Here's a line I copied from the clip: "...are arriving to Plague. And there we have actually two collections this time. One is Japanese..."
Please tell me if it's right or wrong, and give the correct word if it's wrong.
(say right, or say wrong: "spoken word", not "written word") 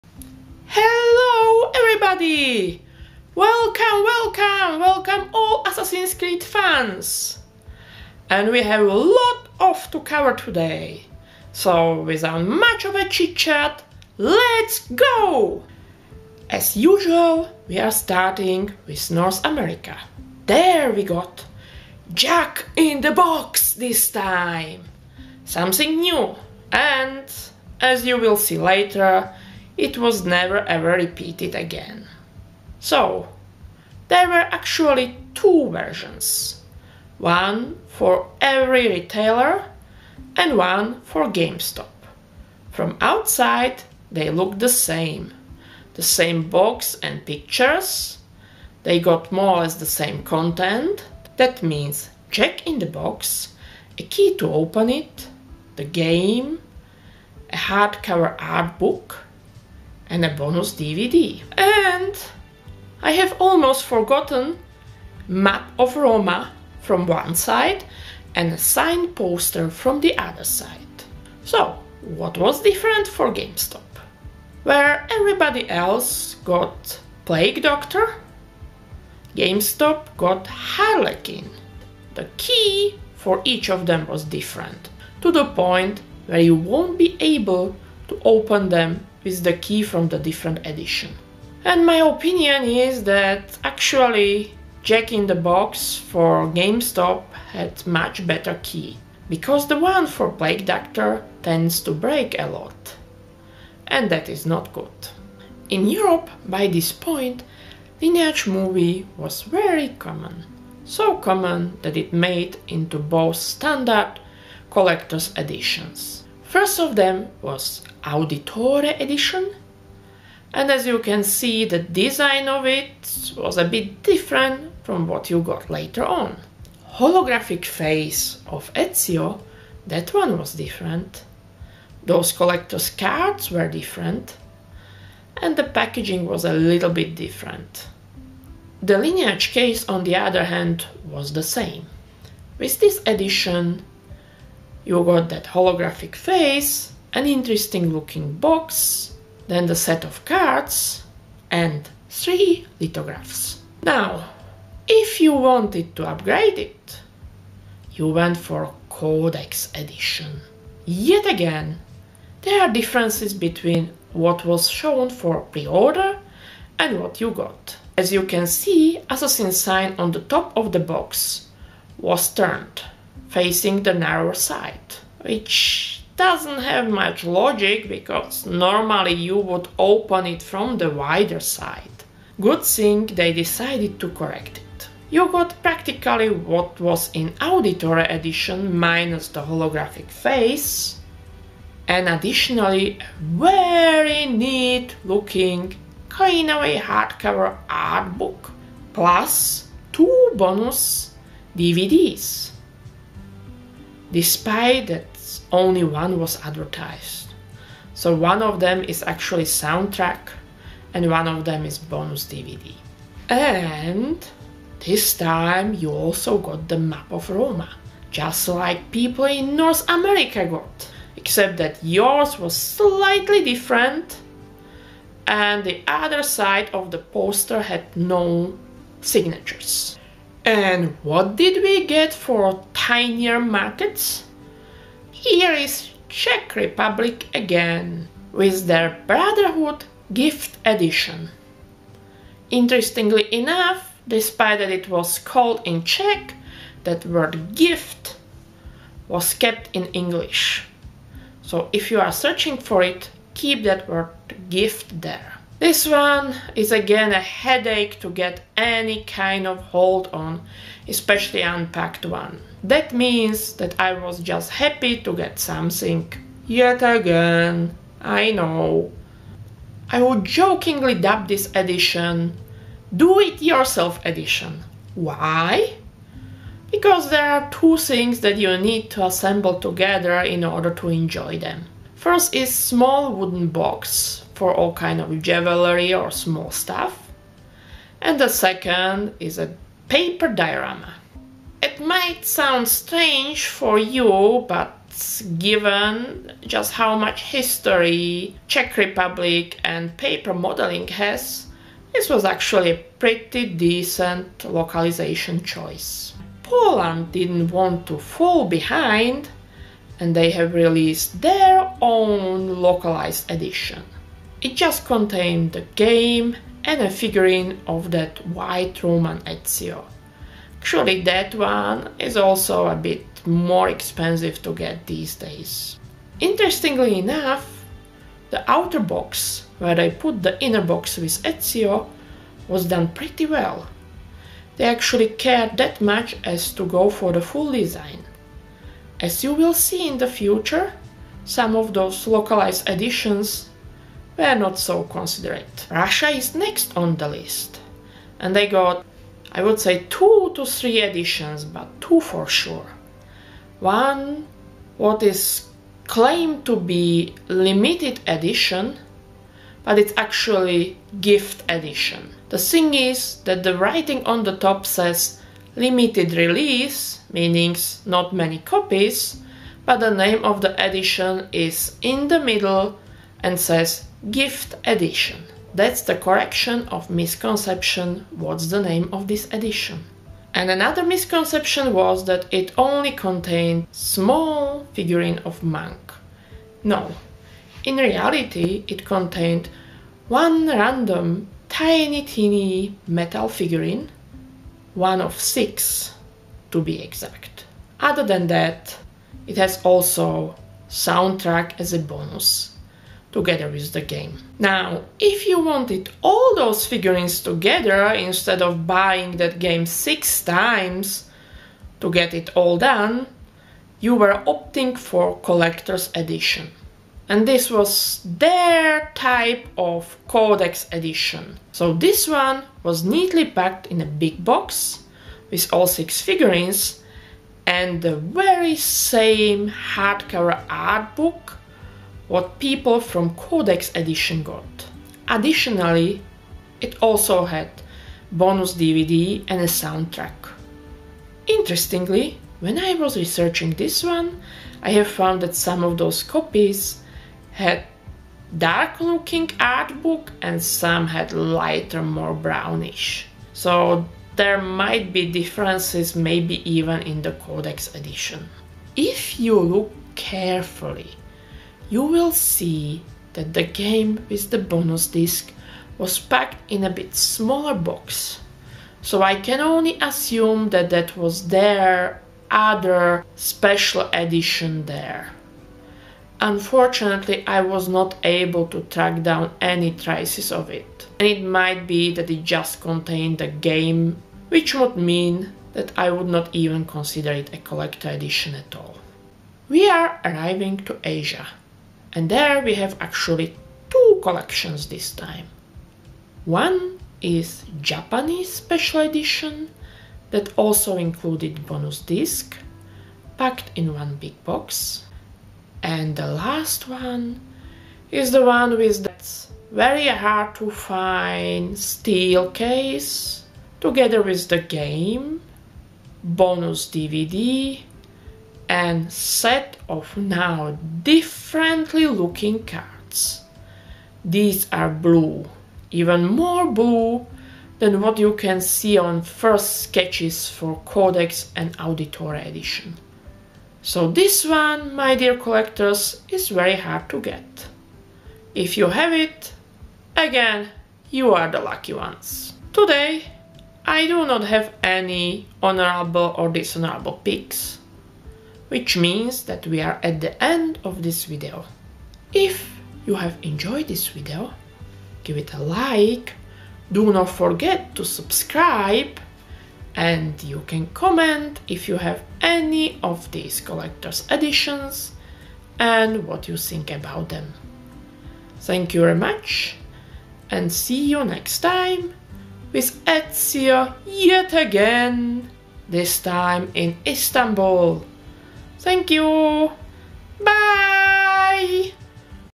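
wrong: "Asia", not "Plague".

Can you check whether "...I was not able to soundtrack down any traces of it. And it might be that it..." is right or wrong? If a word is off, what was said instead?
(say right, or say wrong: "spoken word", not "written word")
wrong: "track", not "soundtrack".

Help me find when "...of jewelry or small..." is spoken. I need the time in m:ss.
4:44.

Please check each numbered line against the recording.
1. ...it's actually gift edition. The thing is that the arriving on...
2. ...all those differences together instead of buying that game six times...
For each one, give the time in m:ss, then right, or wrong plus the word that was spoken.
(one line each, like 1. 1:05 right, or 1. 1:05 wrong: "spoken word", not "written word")
1. 5:59 wrong: "writing", not "arriving"
2. 6:46 wrong: "figurines", not "differences".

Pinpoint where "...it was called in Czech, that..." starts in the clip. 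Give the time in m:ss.
4:04.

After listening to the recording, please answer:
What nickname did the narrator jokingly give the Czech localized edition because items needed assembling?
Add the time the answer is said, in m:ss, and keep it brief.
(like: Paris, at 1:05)
Do-It-Yourself Edition, at 4:32.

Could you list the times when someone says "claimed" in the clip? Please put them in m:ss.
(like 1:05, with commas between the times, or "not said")
5:55.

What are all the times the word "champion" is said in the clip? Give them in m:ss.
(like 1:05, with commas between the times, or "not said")
not said.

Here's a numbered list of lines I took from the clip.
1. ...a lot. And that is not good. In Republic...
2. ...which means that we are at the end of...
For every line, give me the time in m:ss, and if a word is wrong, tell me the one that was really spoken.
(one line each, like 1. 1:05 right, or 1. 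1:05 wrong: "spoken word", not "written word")
1. 1:42 wrong: "Europe", not "Republic"
2. 9:08 right.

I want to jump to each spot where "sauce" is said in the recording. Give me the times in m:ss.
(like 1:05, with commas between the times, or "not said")
not said.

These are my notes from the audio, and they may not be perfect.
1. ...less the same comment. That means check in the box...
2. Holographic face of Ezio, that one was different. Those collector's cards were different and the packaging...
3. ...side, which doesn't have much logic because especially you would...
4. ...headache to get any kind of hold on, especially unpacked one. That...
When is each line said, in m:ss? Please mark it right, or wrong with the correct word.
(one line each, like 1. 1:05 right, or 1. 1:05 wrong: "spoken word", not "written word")
1. 0:49 wrong: "content", not "comment"
2. 2:06 right
3. 2:54 wrong: "normally", not "especially"
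4. 4:17 right.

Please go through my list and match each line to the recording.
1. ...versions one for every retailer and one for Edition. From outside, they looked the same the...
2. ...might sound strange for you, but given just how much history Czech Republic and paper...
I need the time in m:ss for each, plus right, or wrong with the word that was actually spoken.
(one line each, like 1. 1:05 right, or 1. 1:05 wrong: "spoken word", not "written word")
1. 0:35 wrong: "GameStop", not "Edition"
2. 4:51 right.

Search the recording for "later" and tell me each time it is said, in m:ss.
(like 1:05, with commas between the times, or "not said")
0:28, 2:05.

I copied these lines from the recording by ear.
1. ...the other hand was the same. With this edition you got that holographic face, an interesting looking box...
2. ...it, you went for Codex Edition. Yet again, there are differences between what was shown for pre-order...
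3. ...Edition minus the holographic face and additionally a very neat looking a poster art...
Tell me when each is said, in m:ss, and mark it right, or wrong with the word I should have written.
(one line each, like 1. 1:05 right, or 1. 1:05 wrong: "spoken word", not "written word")
1. 2:20 right
2. 2:36 right
3. 3:08 wrong: "hardcover", not "poster".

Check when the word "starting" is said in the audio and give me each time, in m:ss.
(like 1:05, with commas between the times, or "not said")
0:17.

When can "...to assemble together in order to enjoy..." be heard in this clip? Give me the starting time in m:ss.
4:38.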